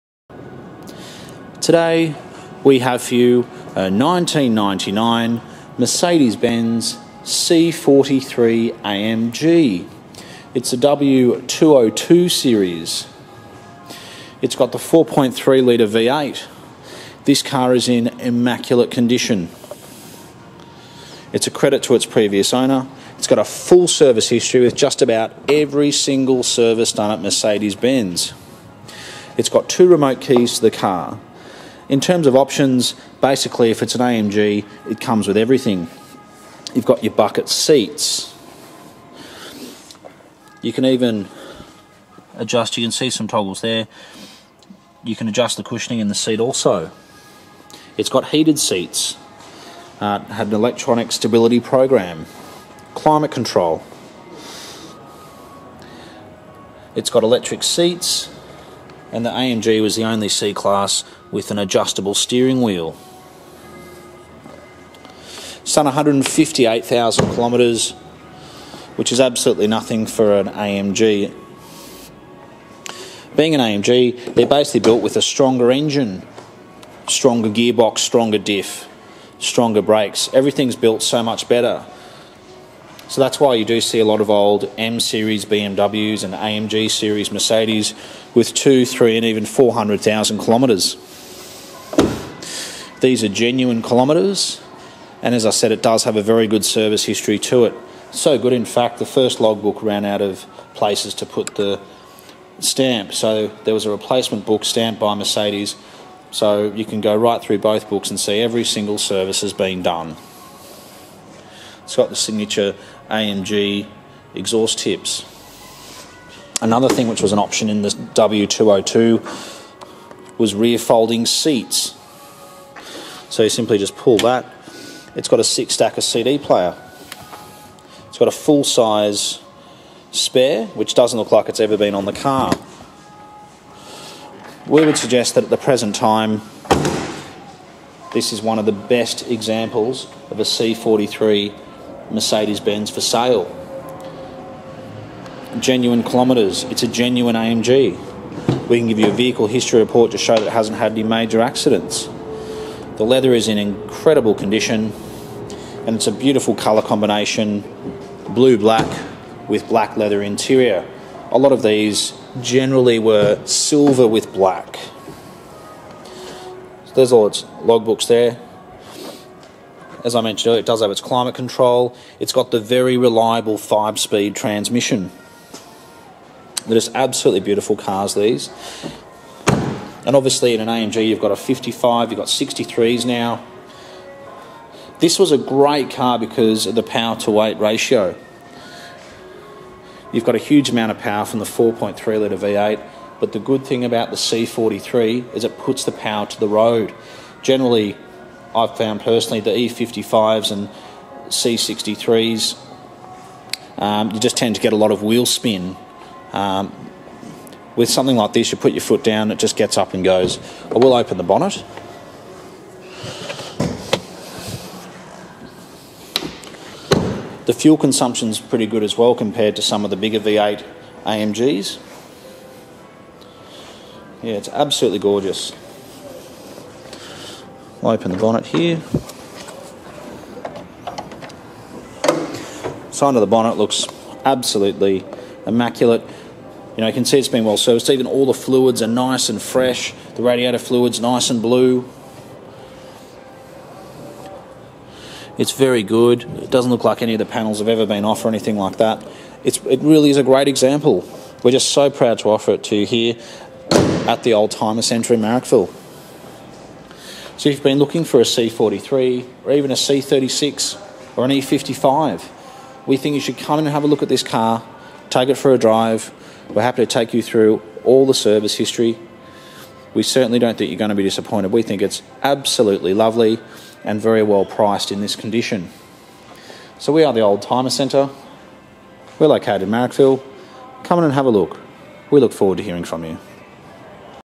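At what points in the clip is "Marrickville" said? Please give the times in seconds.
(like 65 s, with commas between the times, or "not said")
255 s, 279 s.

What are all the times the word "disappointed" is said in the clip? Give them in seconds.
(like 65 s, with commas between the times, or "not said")
271 s.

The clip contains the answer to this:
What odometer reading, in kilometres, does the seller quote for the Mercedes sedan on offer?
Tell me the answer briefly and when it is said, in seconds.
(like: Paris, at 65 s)
158,000, at 65 s.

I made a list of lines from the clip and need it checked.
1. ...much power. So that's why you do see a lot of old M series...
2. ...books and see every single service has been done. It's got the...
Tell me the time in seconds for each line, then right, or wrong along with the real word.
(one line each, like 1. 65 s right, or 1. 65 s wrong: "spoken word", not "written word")
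1. 81 s wrong: "better", not "power"
2. 107 s right.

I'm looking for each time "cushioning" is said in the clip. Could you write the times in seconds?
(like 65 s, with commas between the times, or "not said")
45 s.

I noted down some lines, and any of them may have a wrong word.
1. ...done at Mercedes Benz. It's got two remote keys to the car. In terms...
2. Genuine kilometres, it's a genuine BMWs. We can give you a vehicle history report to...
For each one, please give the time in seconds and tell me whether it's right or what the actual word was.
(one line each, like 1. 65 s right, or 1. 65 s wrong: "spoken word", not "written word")
1. 26 s right
2. 145 s wrong: "AMG", not "BMWs".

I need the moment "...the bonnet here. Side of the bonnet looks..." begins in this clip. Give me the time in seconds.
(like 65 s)
228 s.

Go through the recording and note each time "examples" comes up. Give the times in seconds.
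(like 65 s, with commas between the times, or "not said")
139 s, 250 s.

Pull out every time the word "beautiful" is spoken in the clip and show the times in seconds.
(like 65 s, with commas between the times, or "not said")
156 s, 177 s.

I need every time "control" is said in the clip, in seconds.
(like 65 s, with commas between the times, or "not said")
53 s, 171 s.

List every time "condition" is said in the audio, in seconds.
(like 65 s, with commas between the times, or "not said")
18 s, 154 s, 275 s.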